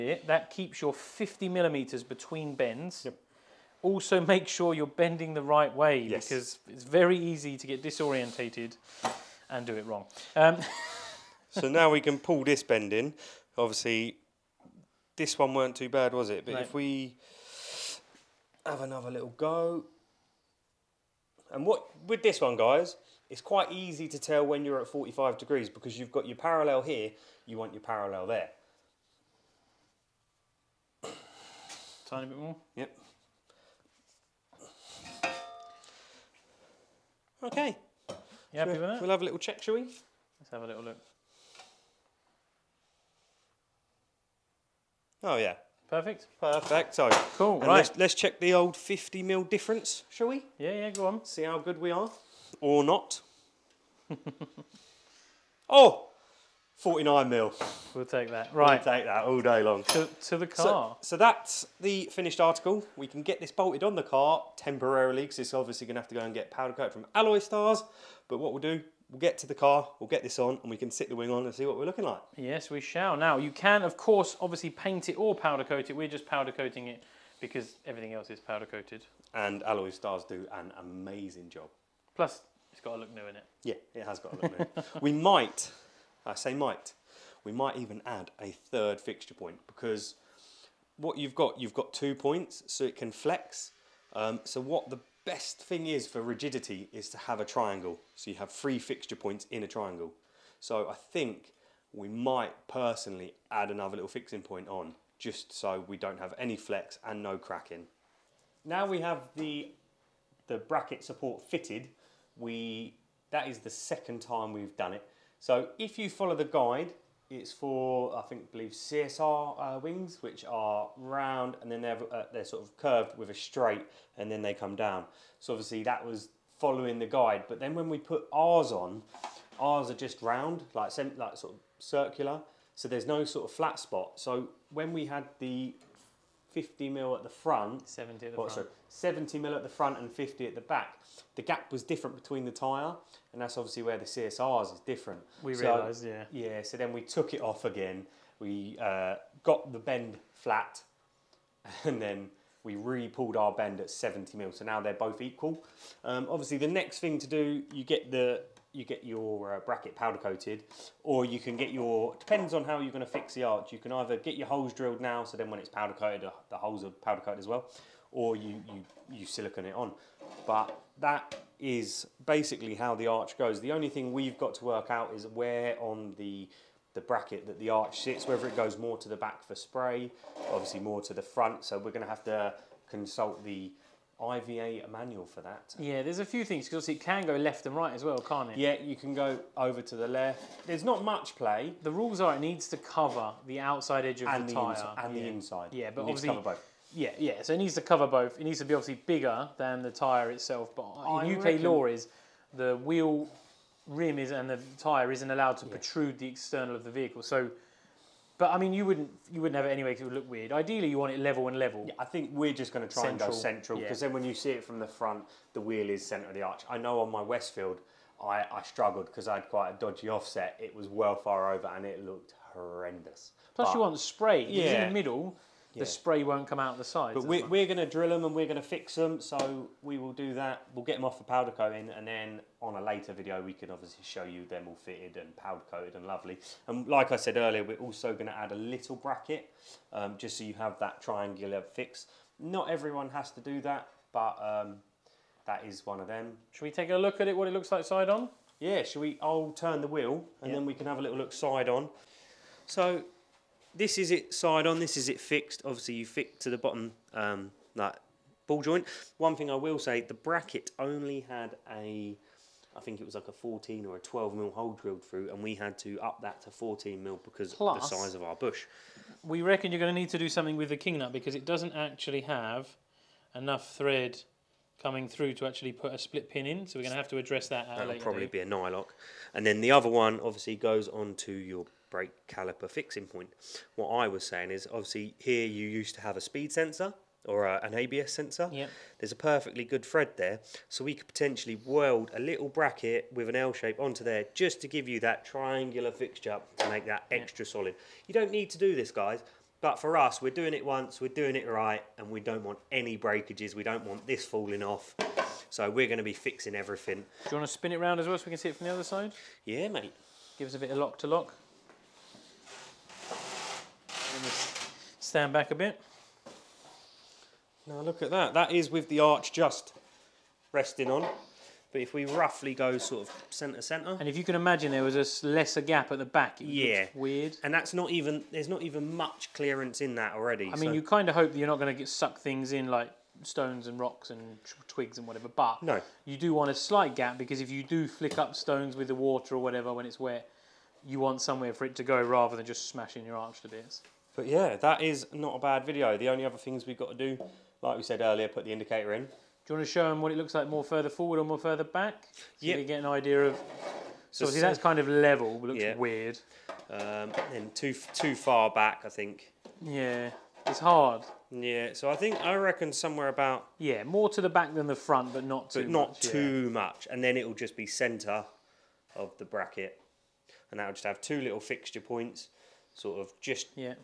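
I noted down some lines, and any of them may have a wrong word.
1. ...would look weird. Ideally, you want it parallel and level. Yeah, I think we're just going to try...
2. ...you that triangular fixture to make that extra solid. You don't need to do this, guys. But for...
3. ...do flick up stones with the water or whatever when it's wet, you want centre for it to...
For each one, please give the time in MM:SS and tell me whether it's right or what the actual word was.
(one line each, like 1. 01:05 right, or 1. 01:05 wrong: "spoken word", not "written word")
1. 03:30 wrong: "level", not "parallel"
2. 04:54 right
3. 05:37 wrong: "somewhere", not "centre".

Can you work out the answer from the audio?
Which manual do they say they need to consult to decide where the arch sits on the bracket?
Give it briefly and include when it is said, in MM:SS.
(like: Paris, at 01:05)
IVA manual, at 03:04.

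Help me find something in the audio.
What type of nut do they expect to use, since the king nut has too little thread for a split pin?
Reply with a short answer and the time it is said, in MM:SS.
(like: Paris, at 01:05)
nylock, at 04:38.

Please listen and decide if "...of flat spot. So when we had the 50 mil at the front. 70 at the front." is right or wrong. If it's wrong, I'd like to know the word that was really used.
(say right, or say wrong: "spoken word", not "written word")
right.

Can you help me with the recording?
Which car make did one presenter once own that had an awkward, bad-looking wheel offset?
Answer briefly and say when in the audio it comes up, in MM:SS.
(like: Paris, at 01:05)
Westfield, at 03:37.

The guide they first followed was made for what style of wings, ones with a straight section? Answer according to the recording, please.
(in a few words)
CSR.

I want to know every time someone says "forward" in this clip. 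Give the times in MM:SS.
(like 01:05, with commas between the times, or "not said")
05:50.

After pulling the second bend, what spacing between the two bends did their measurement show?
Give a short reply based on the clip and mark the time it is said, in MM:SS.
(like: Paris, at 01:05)
49 mm, at 00:56.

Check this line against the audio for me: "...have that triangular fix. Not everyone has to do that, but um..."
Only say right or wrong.
right.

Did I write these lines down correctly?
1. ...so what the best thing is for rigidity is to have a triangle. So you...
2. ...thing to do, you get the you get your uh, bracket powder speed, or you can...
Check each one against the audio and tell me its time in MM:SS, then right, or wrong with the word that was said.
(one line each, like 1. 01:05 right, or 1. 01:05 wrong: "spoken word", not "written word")
1. 01:34 right
2. 02:37 wrong: "coated", not "speed".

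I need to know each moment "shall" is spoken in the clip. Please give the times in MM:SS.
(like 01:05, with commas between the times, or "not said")
00:39, 00:50, 01:12.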